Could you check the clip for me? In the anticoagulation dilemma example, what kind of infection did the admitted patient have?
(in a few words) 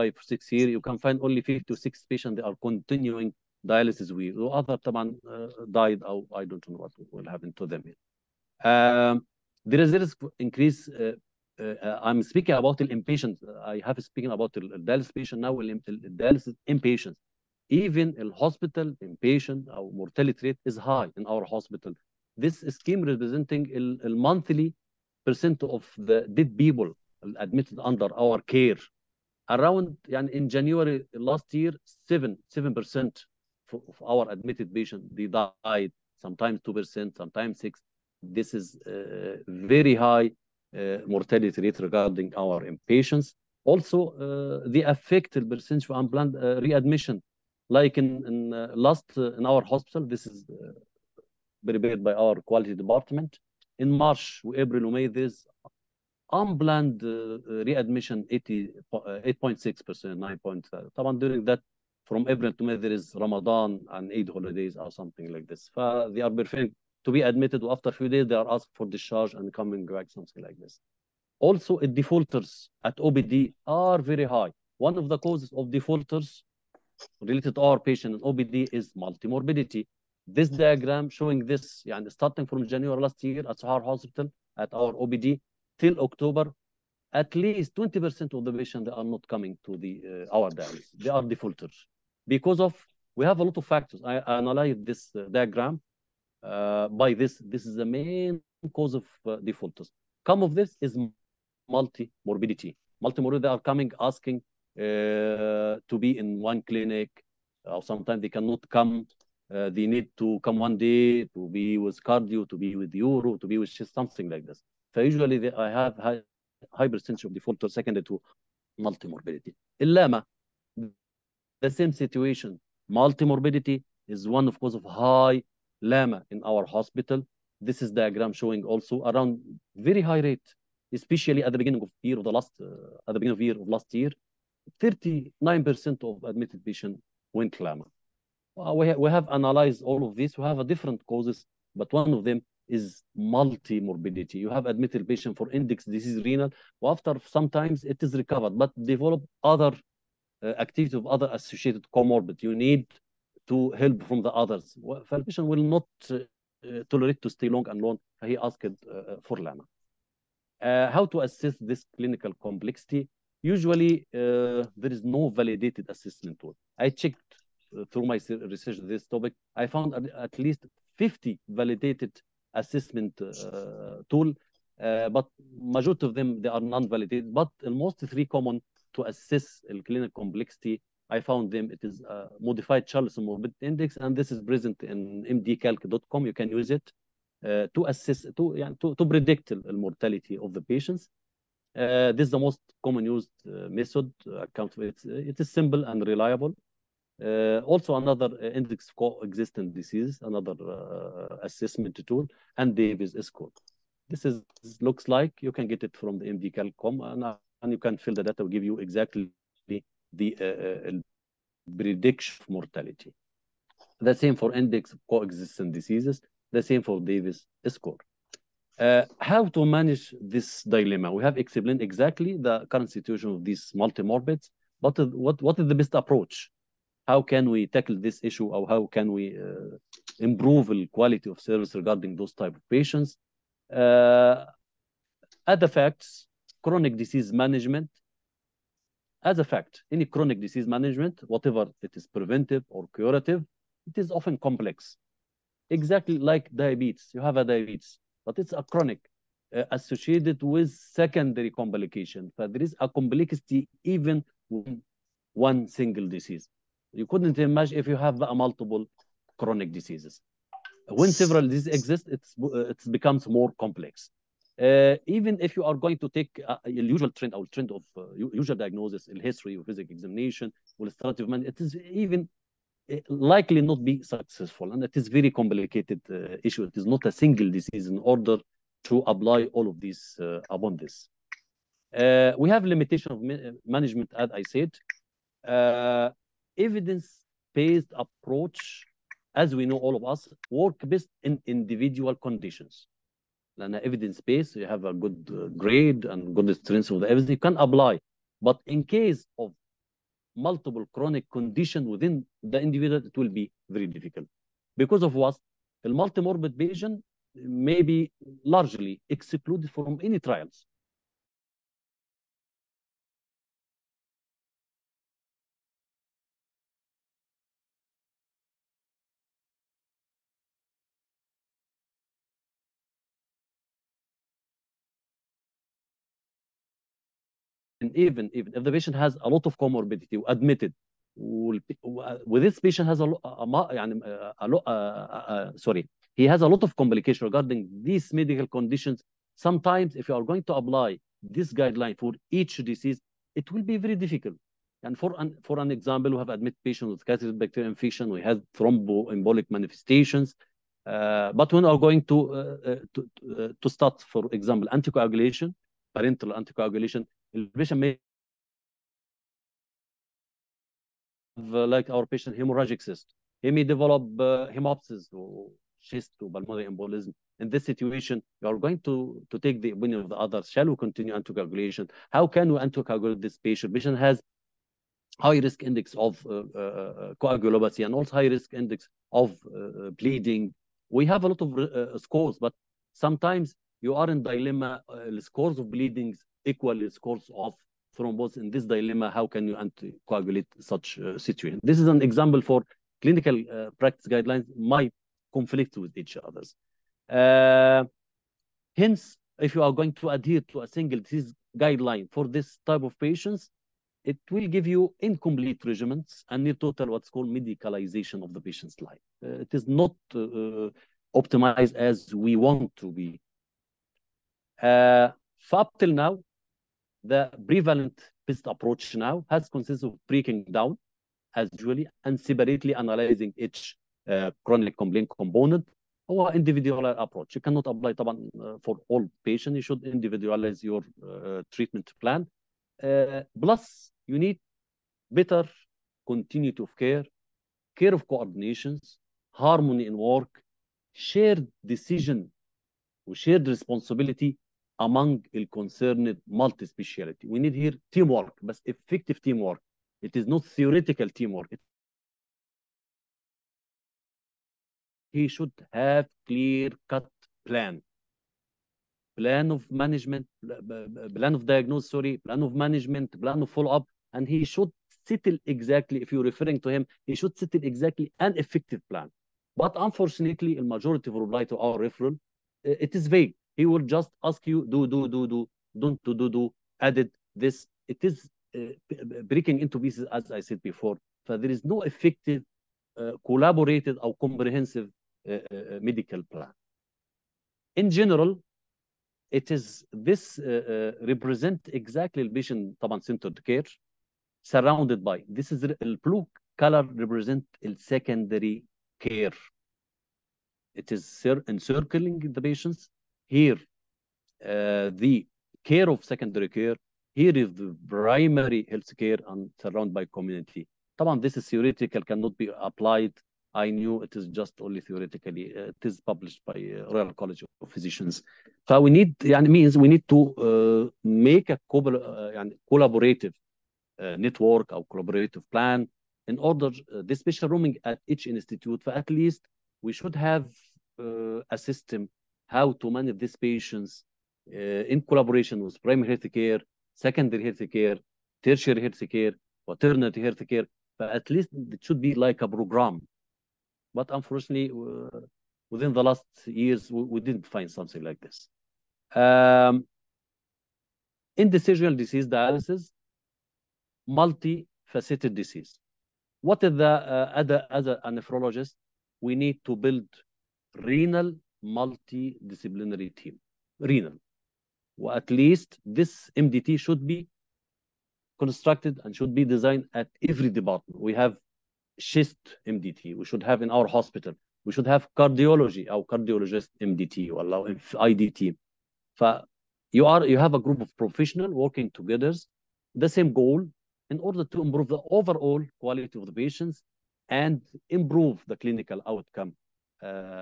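catheter bacterial infection.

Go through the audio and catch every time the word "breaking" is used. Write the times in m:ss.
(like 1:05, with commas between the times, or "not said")
7:00, 7:59.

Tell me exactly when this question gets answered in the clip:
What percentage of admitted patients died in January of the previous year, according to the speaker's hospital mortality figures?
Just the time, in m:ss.
0:32.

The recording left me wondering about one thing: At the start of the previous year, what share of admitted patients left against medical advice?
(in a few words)
39%.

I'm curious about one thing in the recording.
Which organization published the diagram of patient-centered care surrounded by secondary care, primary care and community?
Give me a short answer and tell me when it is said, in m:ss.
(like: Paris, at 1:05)
Royal College of Physicians, at 8:36.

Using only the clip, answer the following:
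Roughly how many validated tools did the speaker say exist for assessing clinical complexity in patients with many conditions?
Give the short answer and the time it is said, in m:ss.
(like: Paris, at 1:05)
50, at 2:49.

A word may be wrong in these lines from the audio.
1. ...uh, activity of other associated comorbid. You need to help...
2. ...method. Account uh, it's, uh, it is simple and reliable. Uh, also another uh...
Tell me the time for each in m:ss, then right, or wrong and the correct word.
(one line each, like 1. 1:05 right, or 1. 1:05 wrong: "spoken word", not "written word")
1. 2:30 right
2. 3:13 right.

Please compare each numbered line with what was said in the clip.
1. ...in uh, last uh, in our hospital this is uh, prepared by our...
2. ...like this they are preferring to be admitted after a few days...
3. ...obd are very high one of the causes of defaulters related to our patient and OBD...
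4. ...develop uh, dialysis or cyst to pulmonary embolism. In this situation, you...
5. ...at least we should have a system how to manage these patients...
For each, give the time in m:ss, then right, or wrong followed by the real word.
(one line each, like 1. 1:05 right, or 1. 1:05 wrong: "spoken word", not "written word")
1. 0:48 right
2. 1:05 right
3. 1:12 right
4. 6:03 wrong: "hemoptysis", not "dialysis"
5. 8:48 right.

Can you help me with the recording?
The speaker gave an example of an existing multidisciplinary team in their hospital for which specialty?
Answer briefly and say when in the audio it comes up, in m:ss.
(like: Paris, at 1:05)
chest, at 9:31.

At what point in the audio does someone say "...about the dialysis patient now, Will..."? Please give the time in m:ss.
0:14.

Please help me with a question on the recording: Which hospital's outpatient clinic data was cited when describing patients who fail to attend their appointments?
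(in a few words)
Sohar Hospital.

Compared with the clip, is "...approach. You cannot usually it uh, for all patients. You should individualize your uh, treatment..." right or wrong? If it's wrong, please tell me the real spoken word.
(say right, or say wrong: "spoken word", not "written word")
wrong: "apply", not "usually".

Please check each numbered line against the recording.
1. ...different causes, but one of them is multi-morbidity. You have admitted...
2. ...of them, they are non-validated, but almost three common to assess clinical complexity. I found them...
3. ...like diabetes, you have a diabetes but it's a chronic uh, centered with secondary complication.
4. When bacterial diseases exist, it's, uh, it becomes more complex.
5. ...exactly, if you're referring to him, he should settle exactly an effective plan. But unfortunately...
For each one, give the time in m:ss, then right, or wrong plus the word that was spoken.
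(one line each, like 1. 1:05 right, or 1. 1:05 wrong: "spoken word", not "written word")
1. 2:20 right
2. 2:56 right
3. 4:06 wrong: "associated", not "centered"
4. 4:21 wrong: "several", not "bacterial"
5. 7:45 right.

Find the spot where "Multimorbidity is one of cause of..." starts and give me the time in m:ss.
2:02.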